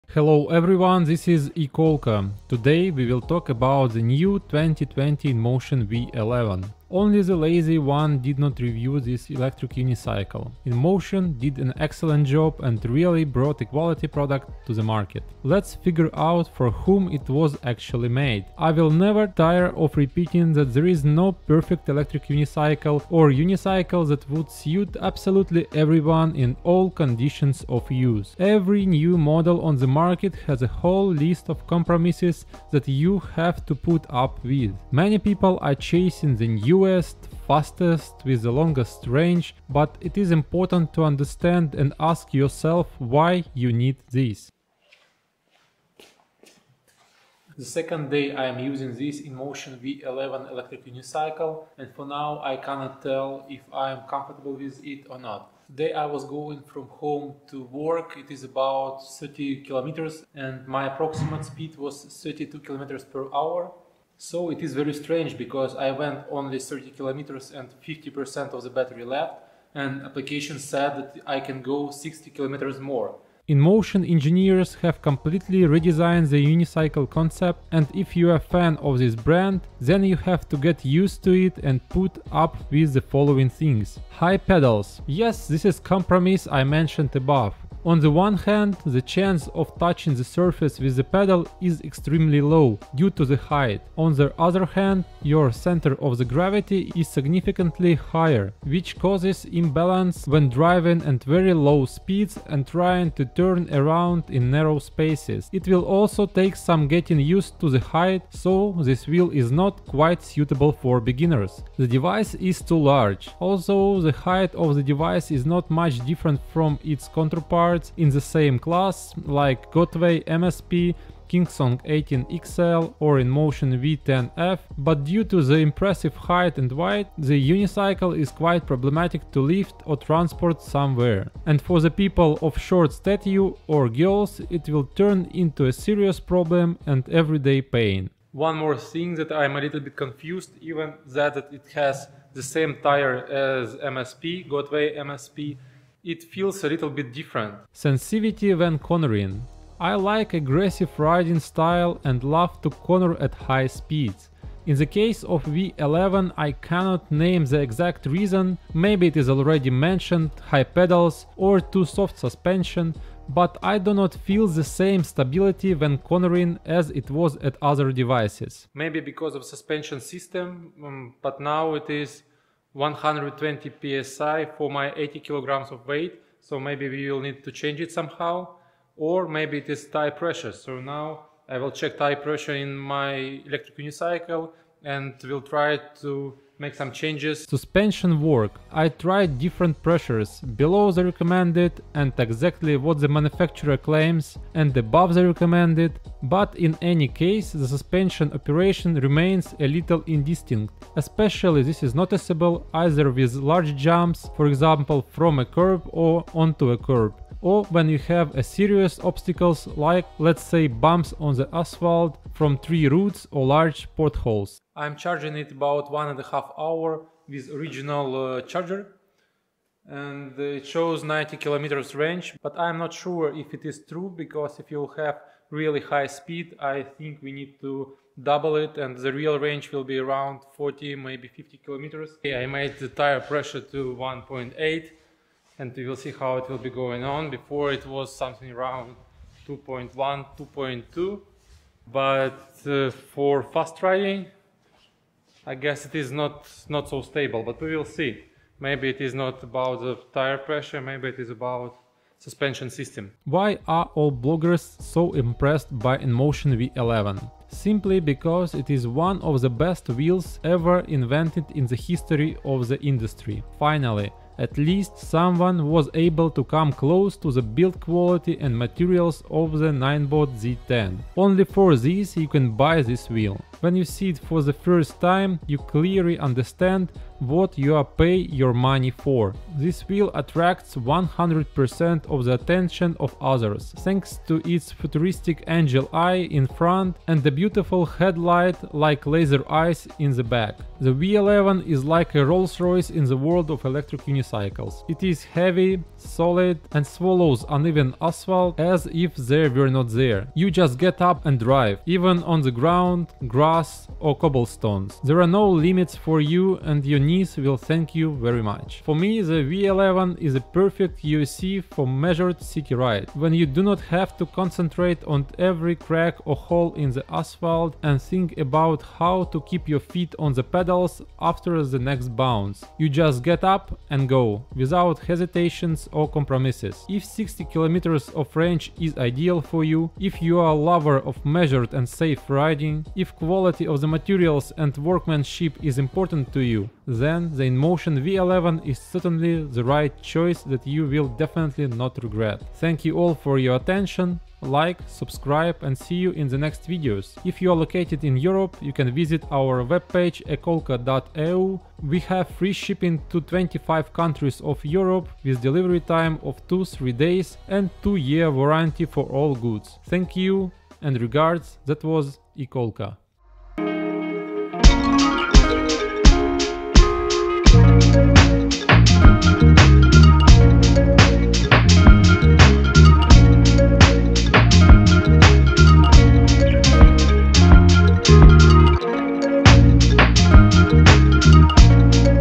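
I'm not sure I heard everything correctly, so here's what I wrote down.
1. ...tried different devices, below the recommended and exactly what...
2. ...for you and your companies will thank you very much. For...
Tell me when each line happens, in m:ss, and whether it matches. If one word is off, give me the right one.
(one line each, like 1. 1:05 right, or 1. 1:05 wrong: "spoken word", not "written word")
1. 3:09 wrong: "pressures", not "devices"
2. 5:05 right.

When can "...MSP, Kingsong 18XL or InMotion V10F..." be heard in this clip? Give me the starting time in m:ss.
2:00.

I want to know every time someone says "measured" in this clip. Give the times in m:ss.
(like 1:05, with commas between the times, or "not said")
5:11, 5:31.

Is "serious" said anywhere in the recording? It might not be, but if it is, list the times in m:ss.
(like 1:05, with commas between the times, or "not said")
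2:15, 3:28.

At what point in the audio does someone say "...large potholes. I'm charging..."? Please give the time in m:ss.
3:33.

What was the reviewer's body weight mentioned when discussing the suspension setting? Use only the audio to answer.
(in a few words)
80 kilograms.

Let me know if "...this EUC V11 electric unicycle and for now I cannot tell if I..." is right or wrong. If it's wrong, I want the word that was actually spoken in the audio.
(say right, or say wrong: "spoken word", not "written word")
wrong: "InMotion", not "EUC".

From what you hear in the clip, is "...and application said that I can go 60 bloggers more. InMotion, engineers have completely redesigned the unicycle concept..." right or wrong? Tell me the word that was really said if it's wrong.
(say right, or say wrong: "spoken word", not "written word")
wrong: "kilometers", not "bloggers".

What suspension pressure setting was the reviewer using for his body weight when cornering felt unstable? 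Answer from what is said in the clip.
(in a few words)
120 psi.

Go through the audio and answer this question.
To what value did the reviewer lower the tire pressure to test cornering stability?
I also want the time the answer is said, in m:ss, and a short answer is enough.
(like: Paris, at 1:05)
1.8, at 3:53.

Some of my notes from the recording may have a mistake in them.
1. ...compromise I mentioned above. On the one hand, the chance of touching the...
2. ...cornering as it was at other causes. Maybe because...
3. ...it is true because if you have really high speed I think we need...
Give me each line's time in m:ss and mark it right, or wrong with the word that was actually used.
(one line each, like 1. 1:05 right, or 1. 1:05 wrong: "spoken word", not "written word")
1. 1:25 right
2. 2:45 wrong: "devices", not "causes"
3. 3:43 right.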